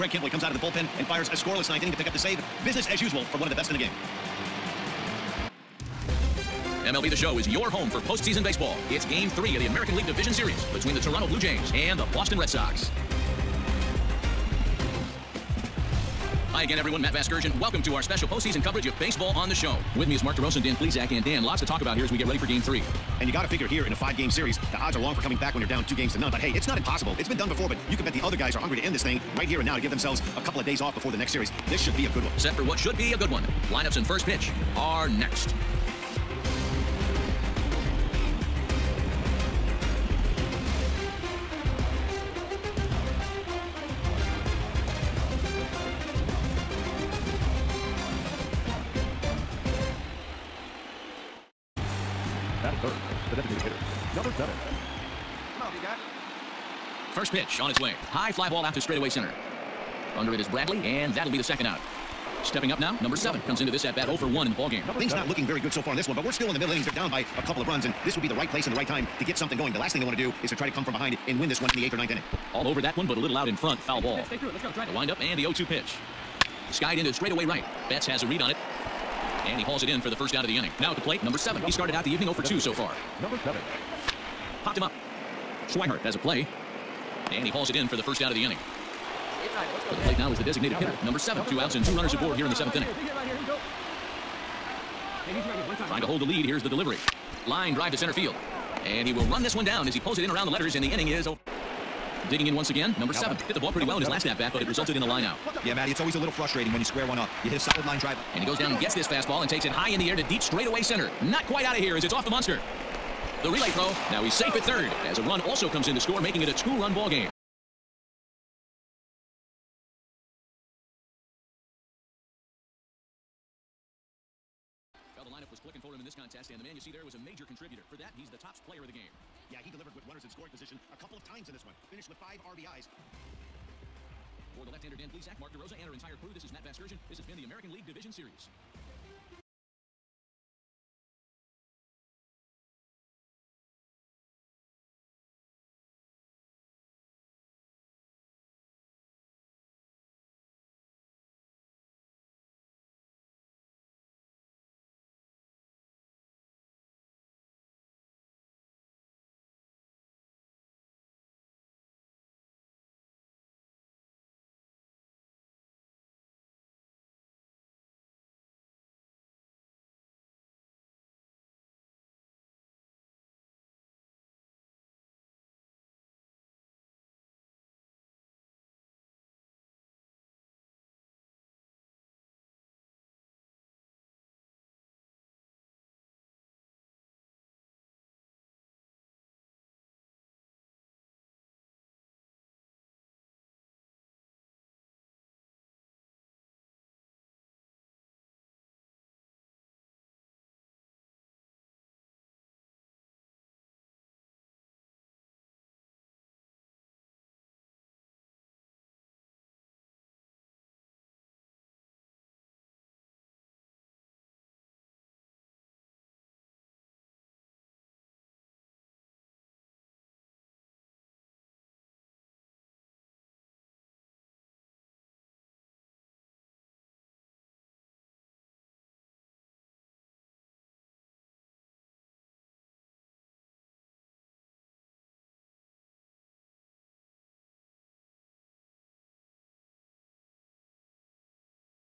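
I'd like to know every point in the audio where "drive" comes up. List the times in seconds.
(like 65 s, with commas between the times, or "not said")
74 s, 97 s, 107 s.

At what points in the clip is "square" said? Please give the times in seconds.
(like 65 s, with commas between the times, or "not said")
106 s.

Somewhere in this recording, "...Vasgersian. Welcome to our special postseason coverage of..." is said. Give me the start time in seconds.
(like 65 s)
17 s.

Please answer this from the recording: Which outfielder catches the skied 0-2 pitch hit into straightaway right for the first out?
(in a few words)
Betts.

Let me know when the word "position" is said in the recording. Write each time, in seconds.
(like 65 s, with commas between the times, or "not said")
130 s.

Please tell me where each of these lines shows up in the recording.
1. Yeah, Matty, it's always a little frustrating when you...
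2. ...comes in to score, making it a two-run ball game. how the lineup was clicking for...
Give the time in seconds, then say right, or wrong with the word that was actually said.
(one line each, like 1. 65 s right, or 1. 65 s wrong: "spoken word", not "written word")
1. 105 s right
2. 115 s right.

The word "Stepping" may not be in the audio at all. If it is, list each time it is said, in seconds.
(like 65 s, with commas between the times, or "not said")
62 s.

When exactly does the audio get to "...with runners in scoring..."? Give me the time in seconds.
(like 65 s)
129 s.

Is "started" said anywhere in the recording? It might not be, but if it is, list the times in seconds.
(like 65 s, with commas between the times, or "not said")
81 s.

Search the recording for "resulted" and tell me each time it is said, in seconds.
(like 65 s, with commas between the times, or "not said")
104 s.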